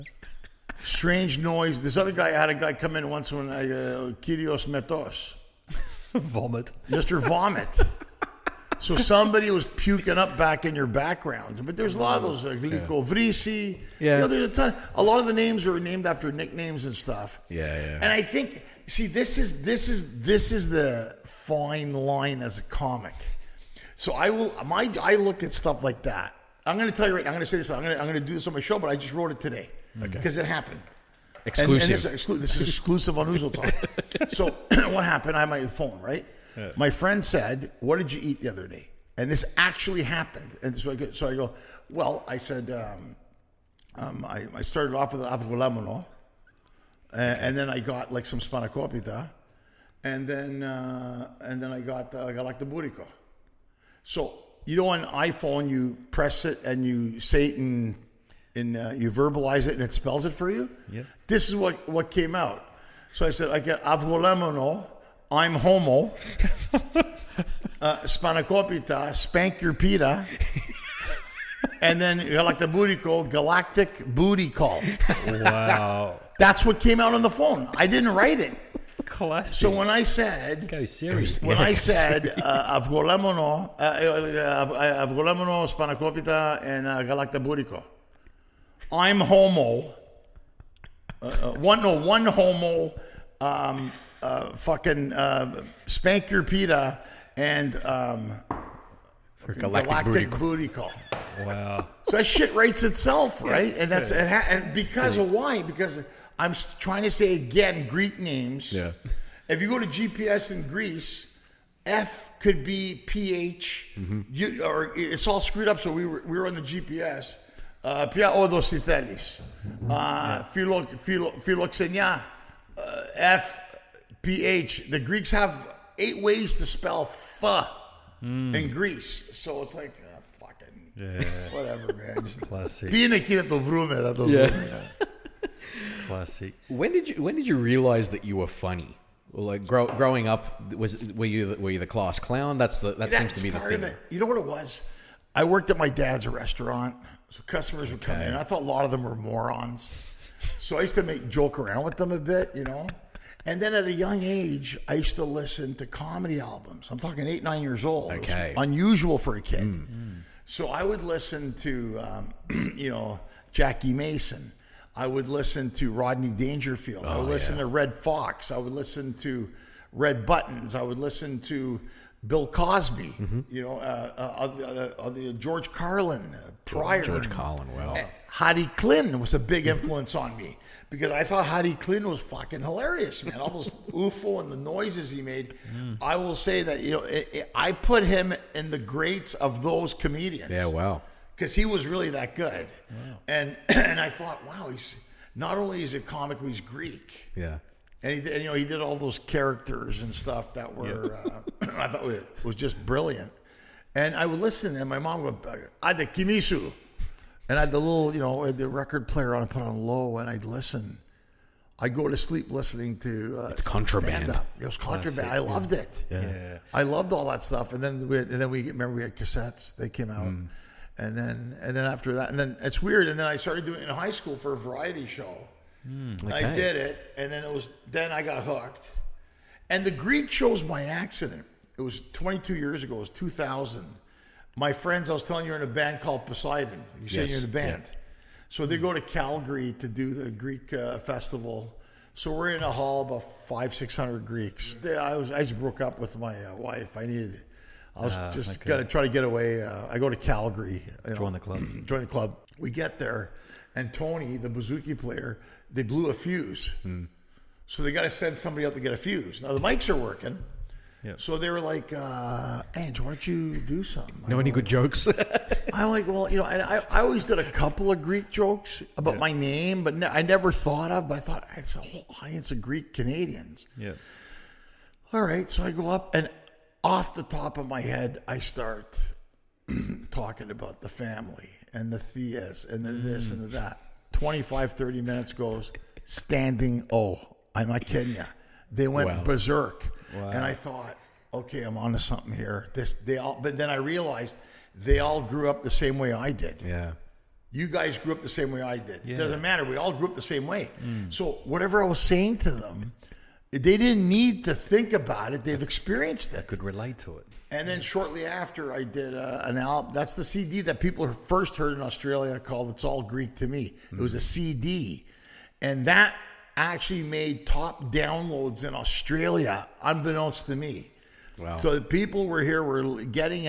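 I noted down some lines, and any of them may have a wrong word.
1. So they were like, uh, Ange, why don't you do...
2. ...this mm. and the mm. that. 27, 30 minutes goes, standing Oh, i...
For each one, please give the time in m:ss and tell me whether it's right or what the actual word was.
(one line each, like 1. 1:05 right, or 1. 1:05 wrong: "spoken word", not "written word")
1. 4:21 right
2. 4:42 wrong: "25", not "27".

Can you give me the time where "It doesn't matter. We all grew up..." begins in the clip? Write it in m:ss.
4:59.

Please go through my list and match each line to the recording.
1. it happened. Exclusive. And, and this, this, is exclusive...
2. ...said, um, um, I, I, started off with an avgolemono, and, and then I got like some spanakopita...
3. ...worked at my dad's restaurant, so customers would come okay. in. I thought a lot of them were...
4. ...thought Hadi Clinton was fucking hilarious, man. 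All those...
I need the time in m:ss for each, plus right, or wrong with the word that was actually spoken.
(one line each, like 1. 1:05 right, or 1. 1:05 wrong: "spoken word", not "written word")
1. 0:30 right
2. 0:42 right
3. 2:25 right
4. 3:01 right.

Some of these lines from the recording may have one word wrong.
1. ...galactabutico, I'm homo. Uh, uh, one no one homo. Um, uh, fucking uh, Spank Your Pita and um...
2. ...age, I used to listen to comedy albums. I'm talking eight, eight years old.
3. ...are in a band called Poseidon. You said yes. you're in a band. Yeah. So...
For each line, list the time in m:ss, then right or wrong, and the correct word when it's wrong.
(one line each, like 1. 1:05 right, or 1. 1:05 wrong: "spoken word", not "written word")
1. 1:27 right
2. 2:34 wrong: "nine", not "eight"
3. 3:55 right.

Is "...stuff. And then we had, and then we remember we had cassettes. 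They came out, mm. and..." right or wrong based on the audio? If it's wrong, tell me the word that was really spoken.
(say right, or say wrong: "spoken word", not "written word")
right.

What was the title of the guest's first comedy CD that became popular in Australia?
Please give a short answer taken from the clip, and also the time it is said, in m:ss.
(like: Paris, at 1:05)
It's All Greek to Me, at 5:12.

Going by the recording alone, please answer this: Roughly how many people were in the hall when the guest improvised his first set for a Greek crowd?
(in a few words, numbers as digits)
500 to 600.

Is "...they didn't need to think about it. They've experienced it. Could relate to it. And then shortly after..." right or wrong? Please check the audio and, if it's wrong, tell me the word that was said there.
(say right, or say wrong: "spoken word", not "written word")
right.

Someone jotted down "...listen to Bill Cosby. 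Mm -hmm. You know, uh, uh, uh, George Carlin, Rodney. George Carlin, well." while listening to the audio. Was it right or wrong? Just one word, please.
wrong.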